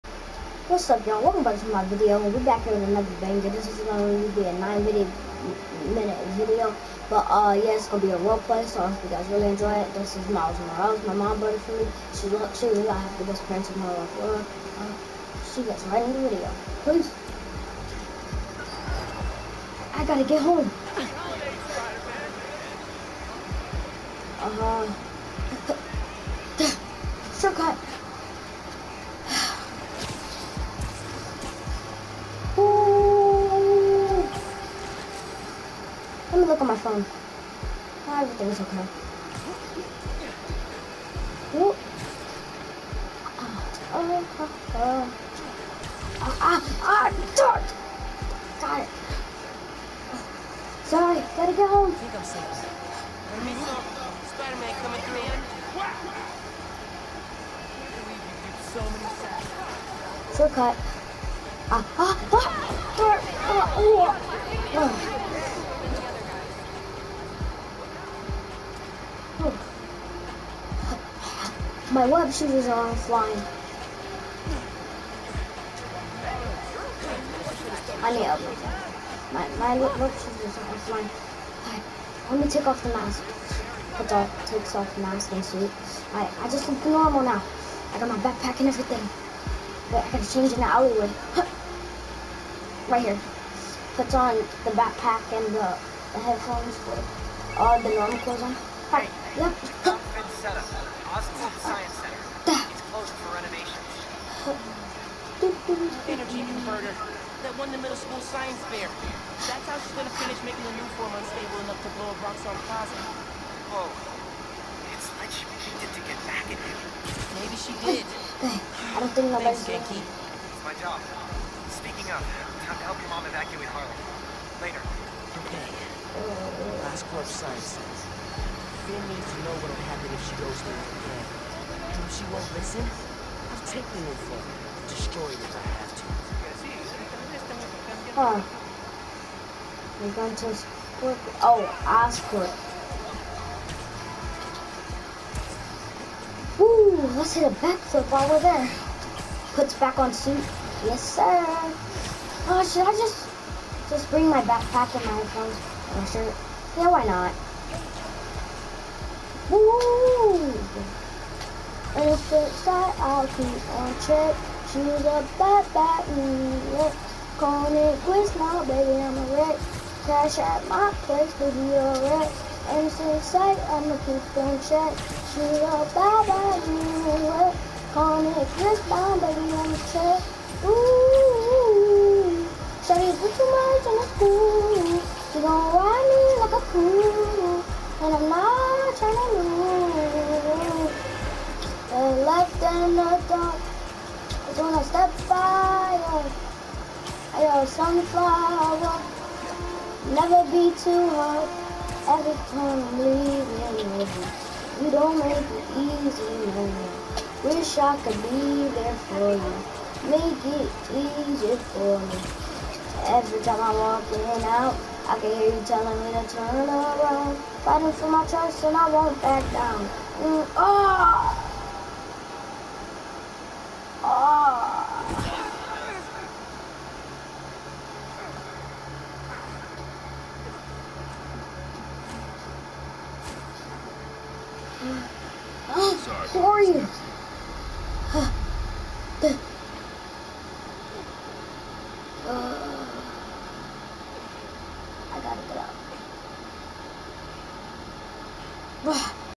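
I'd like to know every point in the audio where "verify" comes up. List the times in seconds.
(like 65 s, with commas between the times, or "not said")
not said.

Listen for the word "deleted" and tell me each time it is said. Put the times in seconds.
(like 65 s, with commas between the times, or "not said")
not said.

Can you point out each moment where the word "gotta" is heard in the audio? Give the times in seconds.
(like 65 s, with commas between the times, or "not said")
20 s, 51 s, 245 s.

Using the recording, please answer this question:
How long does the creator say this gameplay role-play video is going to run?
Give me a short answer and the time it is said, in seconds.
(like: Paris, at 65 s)
9 minutes, at 4 s.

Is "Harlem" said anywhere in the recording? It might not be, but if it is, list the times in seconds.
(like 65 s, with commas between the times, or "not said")
123 s.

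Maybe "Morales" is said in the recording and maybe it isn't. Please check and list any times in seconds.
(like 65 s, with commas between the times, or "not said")
10 s.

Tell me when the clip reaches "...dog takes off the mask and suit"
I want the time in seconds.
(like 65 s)
84 s.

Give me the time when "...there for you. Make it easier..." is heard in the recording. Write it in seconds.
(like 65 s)
208 s.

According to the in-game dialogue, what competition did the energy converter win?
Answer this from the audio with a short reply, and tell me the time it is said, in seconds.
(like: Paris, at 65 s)
middle school science fair, at 107 s.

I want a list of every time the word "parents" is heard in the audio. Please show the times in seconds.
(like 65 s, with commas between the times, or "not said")
13 s.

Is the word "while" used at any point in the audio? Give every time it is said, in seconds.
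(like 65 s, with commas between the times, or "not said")
148 s.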